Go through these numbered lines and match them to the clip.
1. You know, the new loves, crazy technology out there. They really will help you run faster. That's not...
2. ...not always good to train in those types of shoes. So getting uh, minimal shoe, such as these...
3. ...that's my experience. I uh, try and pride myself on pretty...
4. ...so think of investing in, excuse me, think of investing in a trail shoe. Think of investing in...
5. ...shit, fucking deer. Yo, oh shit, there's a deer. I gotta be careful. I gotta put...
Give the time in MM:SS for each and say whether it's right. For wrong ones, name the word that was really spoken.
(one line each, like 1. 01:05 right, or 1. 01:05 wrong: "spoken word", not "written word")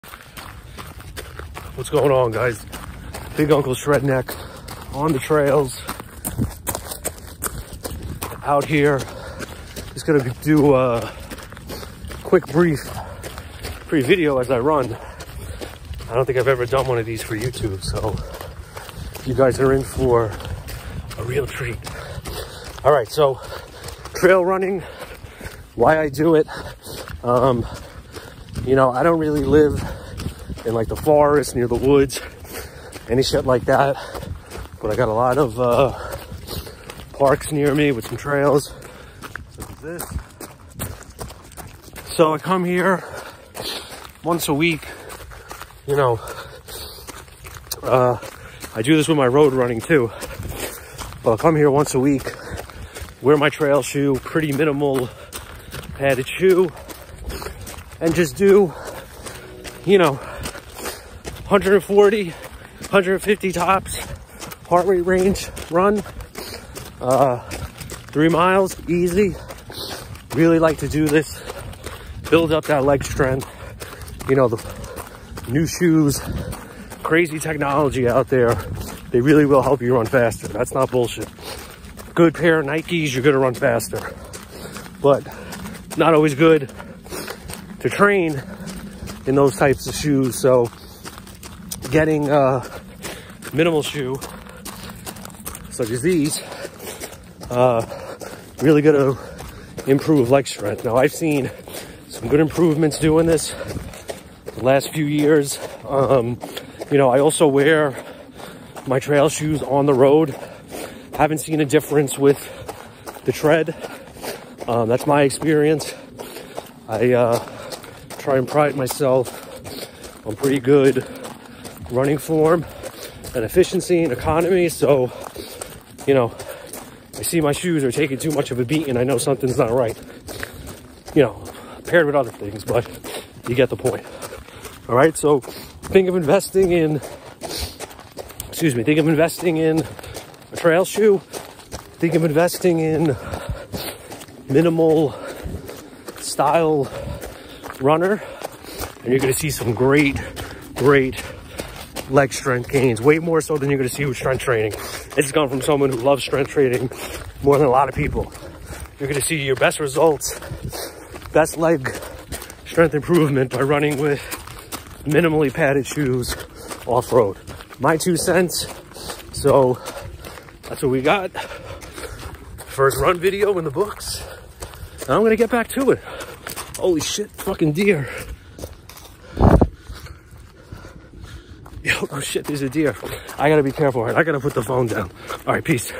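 1. 01:14 wrong: "shoes", not "loves"
2. 01:25 right
3. 01:54 right
4. 02:15 right
5. 02:57 right.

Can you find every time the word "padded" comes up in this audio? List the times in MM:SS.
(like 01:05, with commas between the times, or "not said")
00:55, 02:45.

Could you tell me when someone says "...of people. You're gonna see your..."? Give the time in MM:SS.
02:37.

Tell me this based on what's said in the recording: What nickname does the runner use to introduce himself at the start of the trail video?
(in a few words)
Big Uncle Shredneck.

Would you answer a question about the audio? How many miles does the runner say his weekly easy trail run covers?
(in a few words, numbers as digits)
3.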